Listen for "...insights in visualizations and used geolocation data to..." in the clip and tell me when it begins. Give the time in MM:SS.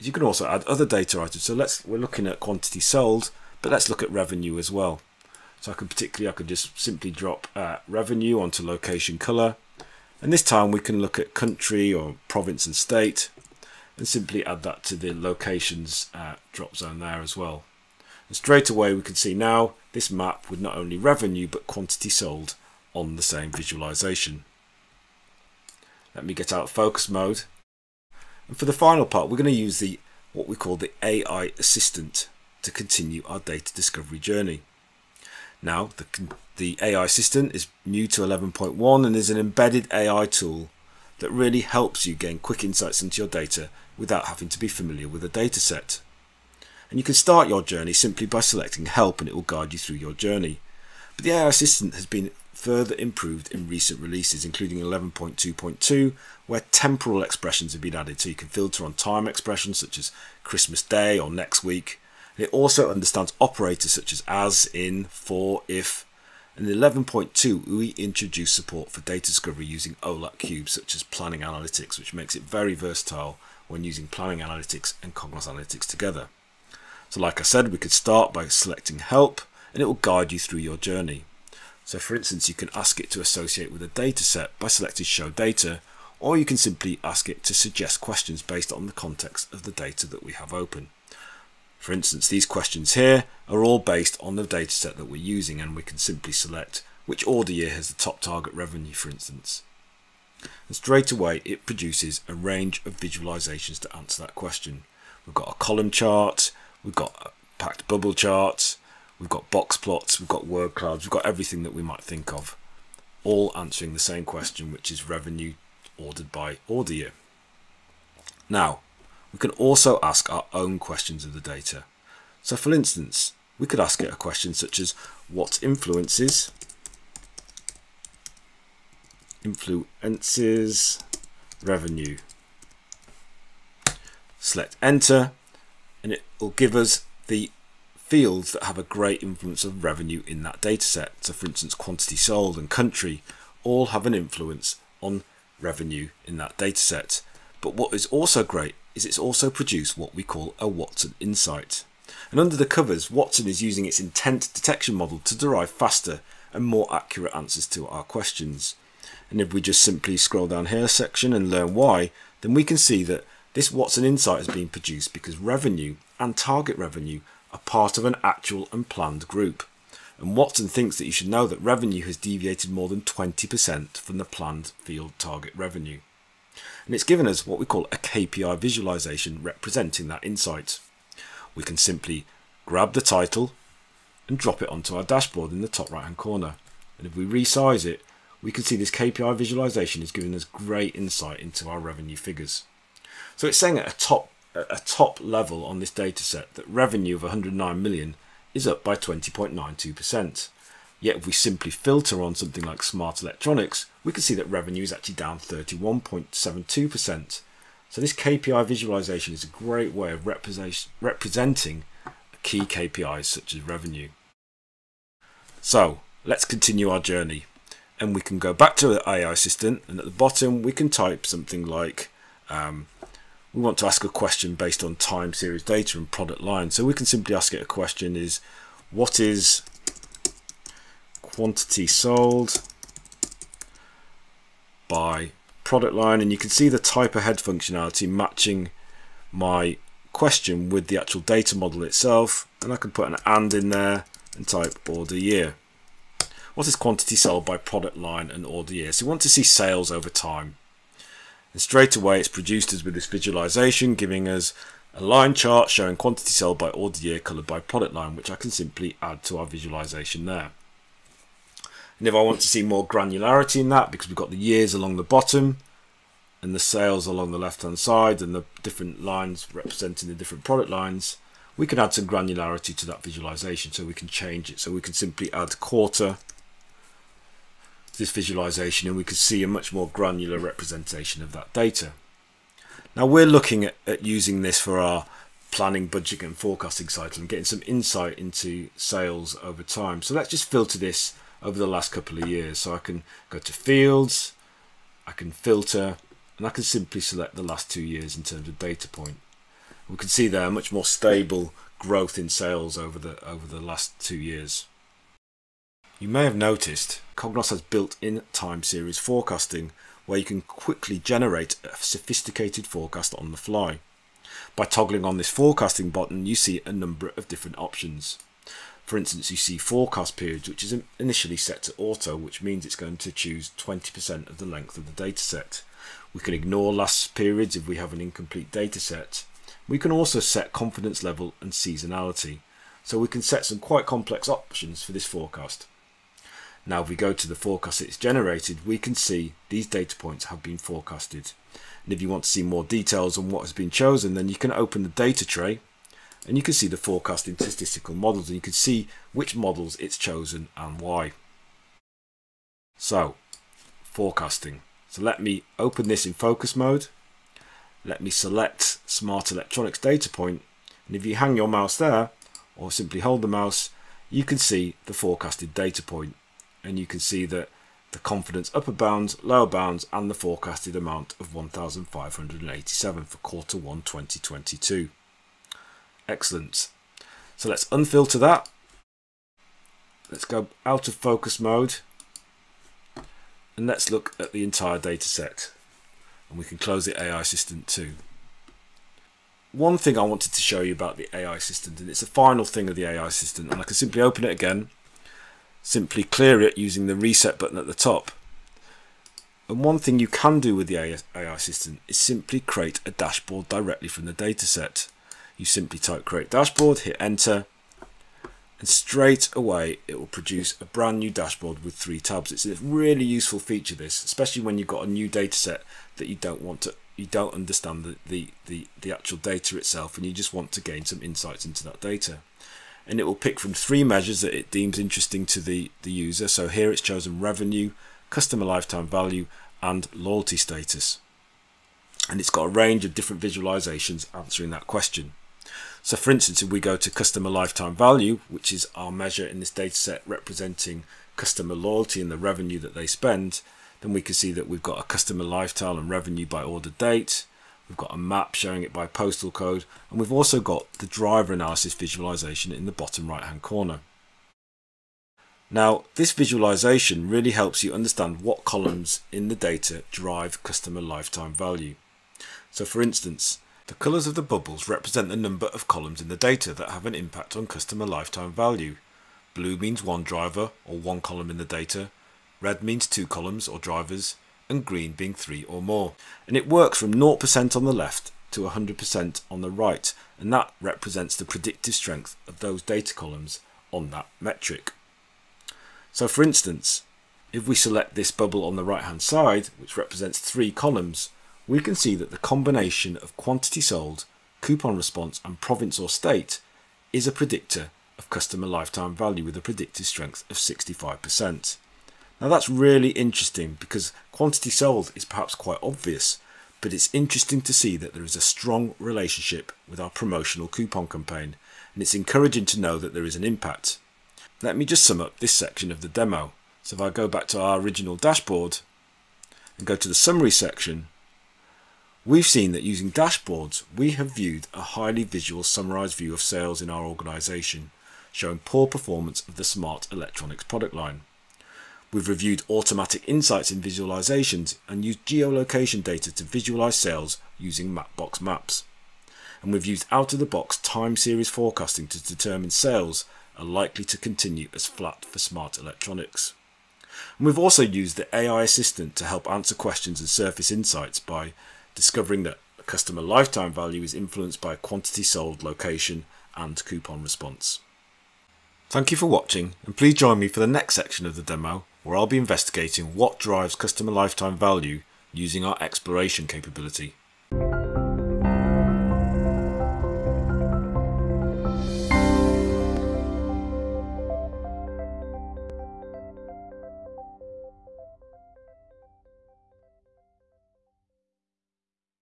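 08:53.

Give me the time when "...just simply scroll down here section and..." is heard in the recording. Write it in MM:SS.
02:39.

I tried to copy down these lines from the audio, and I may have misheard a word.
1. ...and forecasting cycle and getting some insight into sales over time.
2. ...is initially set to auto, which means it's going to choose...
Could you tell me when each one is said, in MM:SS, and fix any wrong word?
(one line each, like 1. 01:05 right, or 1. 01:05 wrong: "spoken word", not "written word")
1. 04:46 right
2. 05:20 right.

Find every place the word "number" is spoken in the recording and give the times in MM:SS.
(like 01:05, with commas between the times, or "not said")
05:16, 07:45.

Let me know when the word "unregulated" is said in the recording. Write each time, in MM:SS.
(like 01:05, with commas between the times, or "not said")
not said.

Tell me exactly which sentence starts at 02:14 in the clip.
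Select enter and it will give us the fields that have a great influence of revenue in that dataset.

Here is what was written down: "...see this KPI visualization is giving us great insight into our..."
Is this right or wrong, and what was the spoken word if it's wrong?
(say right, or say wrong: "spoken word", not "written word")
right.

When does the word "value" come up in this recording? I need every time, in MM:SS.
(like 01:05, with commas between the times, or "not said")
07:08, 07:17, 07:41, 07:48, 08:18, 09:13, 09:24.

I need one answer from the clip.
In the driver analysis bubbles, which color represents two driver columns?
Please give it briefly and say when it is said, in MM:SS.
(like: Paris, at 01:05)
Red, at 07:52.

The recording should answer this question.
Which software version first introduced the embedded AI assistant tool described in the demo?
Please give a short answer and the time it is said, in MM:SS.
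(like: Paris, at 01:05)
11.1, at 00:38.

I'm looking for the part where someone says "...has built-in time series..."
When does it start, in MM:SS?
05:07.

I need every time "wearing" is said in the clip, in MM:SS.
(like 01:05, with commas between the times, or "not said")
not said.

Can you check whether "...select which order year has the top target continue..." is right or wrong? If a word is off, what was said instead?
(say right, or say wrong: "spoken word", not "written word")
wrong: "revenue", not "continue".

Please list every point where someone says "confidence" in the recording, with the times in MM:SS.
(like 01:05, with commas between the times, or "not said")
05:30, 06:07.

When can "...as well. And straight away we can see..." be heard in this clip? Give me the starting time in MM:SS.
00:17.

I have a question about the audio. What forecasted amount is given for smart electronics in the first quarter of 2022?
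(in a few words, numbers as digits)
1,587.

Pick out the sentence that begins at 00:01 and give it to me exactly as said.
So let's we're looking at quantity sold but let's look at revenue as well.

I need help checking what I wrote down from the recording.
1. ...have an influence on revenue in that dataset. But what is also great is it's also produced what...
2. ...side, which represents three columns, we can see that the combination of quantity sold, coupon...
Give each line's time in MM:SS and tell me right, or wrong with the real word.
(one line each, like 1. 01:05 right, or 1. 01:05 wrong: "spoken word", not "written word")
1. 02:23 right
2. 08:09 right.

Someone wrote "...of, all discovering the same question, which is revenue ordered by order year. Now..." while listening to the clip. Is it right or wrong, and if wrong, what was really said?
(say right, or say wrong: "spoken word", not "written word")
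wrong: "answering", not "discovering".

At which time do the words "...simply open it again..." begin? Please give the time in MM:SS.
06:33.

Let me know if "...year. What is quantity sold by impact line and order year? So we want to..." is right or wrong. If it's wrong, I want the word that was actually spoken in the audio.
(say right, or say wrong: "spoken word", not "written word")
wrong: "product", not "impact".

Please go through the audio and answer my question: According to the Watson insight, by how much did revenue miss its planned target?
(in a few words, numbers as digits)
More than 20%.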